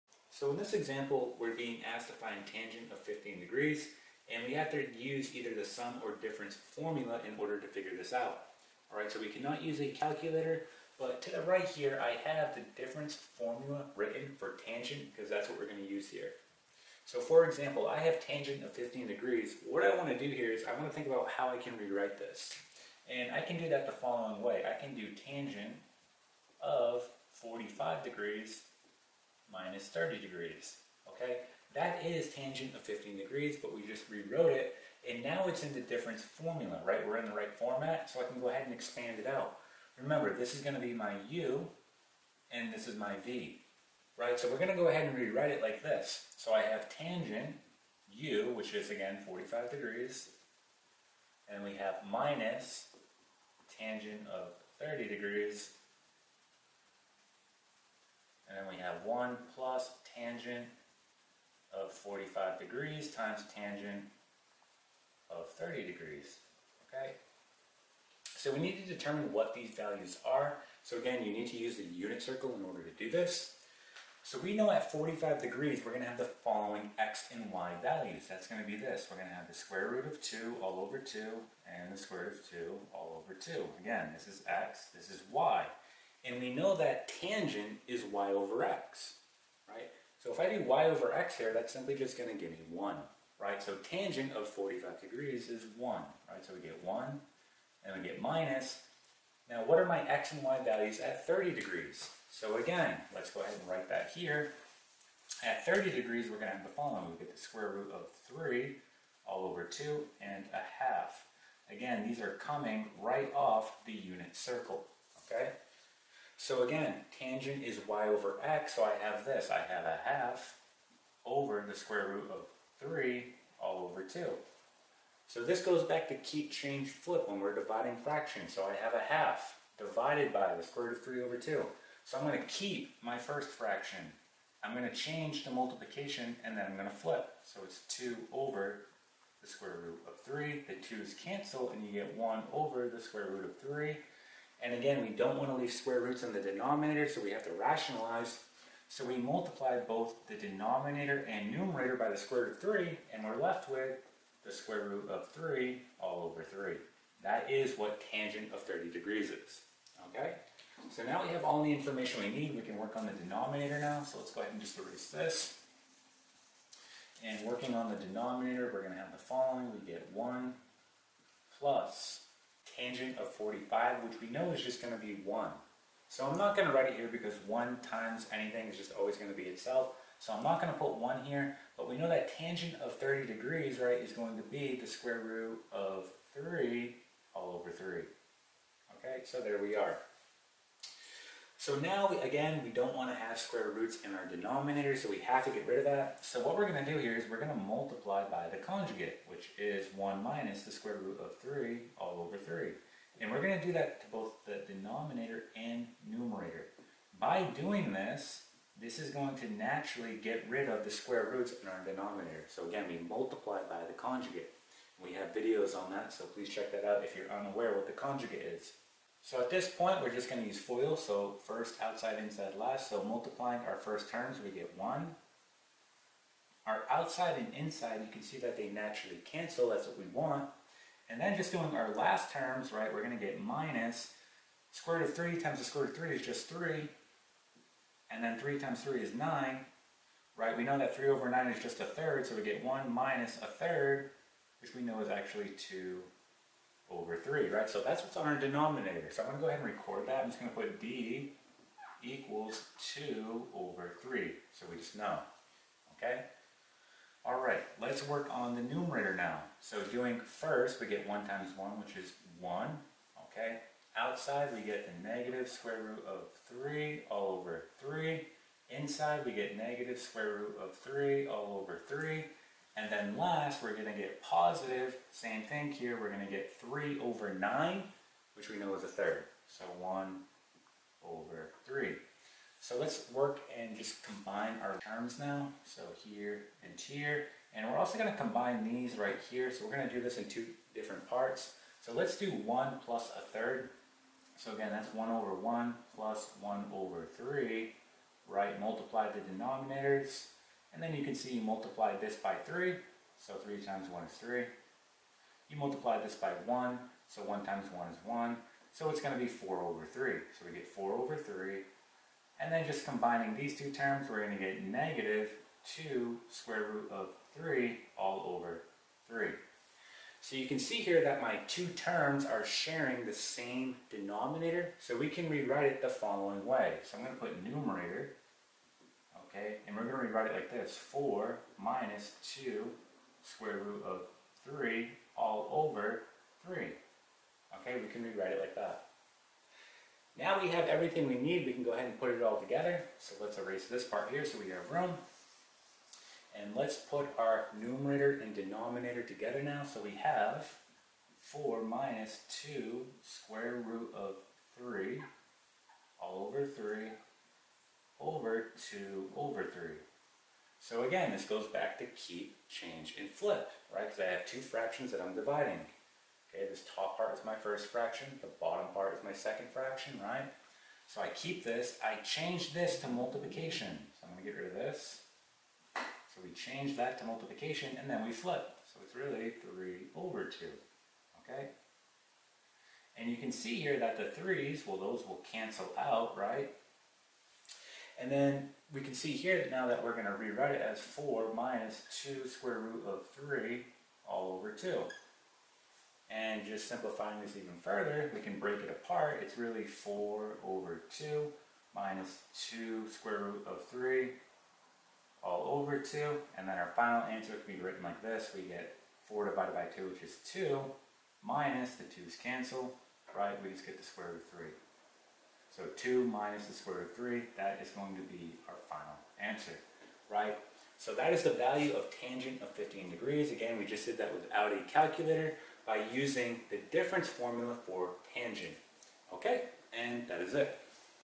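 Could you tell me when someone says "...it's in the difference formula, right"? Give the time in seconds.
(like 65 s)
35 s.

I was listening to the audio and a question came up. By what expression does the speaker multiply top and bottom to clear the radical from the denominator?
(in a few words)
1 minus the square root of 3.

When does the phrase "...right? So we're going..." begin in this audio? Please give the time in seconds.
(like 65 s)
44 s.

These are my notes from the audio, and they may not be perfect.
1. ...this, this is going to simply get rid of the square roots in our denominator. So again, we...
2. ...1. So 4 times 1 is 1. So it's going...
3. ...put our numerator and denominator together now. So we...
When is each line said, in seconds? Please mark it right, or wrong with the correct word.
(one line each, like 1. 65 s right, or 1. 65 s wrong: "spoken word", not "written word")
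1. 207 s wrong: "naturally", not "simply"
2. 306 s wrong: "1", not "4"
3. 346 s right.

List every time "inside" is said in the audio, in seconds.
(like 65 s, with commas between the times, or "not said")
222 s, 227 s, 268 s.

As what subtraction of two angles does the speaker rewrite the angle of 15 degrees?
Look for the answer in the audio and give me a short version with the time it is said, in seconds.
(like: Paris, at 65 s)
45 degrees minus 30 degrees, at 27 s.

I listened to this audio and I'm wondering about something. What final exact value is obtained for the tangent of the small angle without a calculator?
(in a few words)
2 minus the square root of 3.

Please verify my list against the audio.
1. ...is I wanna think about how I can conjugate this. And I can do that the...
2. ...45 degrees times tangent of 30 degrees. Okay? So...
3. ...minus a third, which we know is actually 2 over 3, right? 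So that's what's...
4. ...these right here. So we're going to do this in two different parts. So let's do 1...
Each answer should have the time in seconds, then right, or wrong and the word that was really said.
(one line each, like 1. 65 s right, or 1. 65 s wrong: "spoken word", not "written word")
1. 20 s wrong: "rewrite", not "conjugate"
2. 61 s right
3. 242 s right
4. 288 s right.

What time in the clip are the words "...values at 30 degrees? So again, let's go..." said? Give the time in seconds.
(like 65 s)
100 s.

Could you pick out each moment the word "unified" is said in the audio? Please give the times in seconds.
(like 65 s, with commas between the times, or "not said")
not said.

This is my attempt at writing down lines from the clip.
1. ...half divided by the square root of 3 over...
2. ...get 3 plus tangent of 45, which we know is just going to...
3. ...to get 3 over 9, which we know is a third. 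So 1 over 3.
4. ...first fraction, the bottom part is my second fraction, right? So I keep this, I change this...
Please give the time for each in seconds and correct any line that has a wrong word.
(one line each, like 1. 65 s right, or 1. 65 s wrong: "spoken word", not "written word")
1. 129 s right
2. 169 s wrong: "1", not "3"
3. 276 s right
4. 367 s right.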